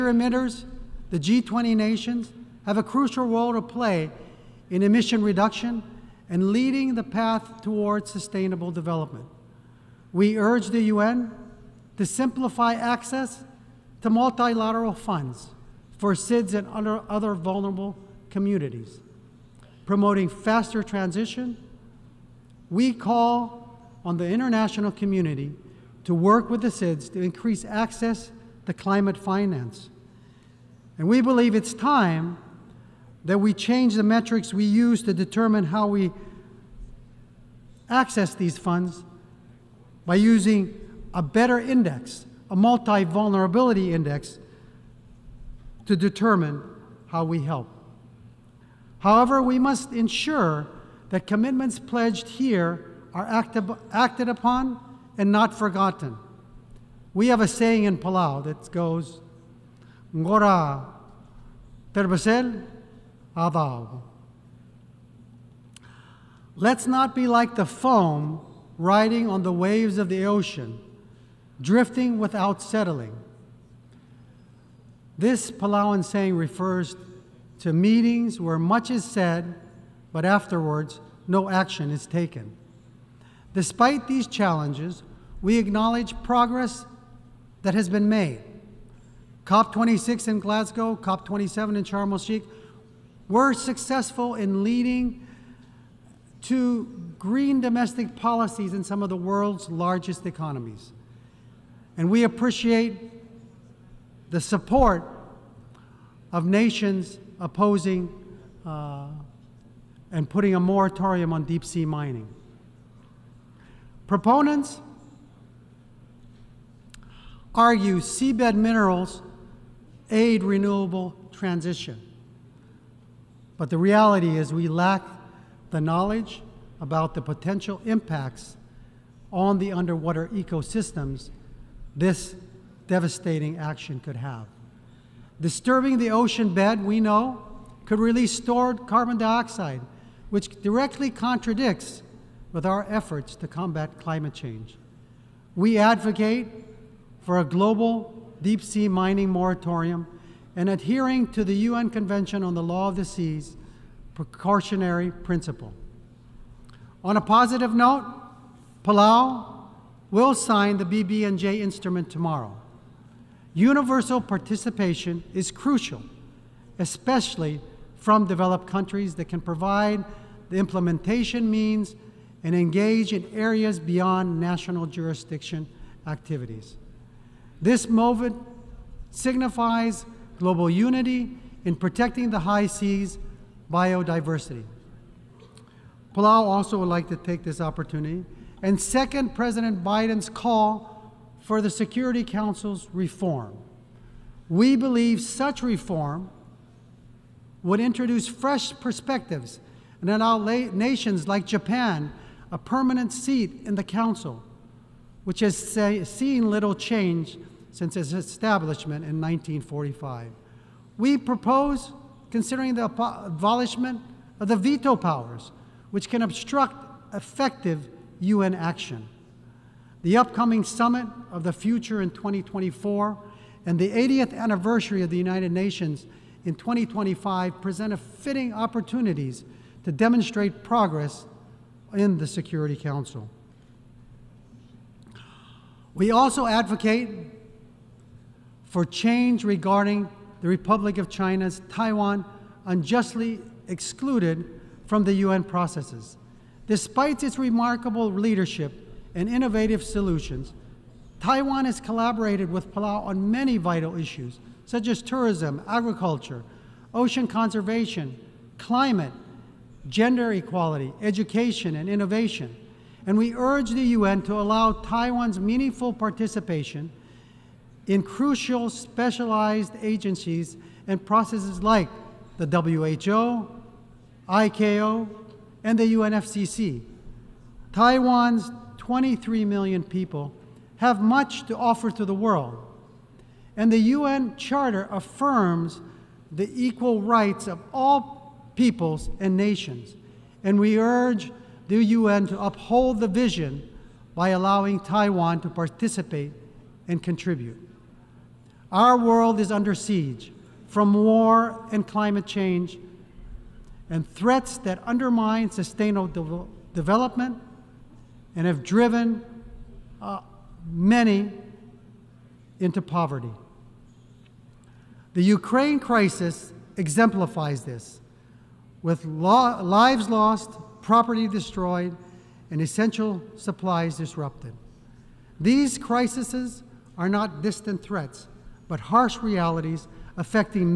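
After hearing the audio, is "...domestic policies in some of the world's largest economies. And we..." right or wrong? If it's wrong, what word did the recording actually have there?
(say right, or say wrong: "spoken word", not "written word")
right.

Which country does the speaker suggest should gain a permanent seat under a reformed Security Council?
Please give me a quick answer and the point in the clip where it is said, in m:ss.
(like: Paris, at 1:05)
Japan, at 3:21.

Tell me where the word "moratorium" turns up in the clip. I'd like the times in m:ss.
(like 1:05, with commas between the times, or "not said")
1:50, 2:29.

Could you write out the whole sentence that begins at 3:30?
We propose considering the abolishment of the veto powers, which can obstruct effective UN action.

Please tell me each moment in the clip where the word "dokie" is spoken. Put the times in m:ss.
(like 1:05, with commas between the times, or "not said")
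not said.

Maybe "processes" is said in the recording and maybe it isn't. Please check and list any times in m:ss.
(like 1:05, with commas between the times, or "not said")
4:05, 4:31.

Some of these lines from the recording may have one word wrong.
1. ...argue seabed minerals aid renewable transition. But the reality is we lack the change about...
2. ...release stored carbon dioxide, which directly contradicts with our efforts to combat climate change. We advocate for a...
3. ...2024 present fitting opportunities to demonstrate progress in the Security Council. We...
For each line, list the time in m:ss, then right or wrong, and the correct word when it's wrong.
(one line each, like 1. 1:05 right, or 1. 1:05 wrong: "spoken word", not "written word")
1. 1:57 wrong: "knowledge", not "change"
2. 2:17 right
3. 3:46 wrong: "2025", not "2024".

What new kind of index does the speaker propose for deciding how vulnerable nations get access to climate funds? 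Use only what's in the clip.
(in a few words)
multi-vulnerability index.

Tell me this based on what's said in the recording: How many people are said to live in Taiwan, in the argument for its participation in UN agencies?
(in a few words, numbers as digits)
23 million.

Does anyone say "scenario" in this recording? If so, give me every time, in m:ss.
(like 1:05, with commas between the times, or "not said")
not said.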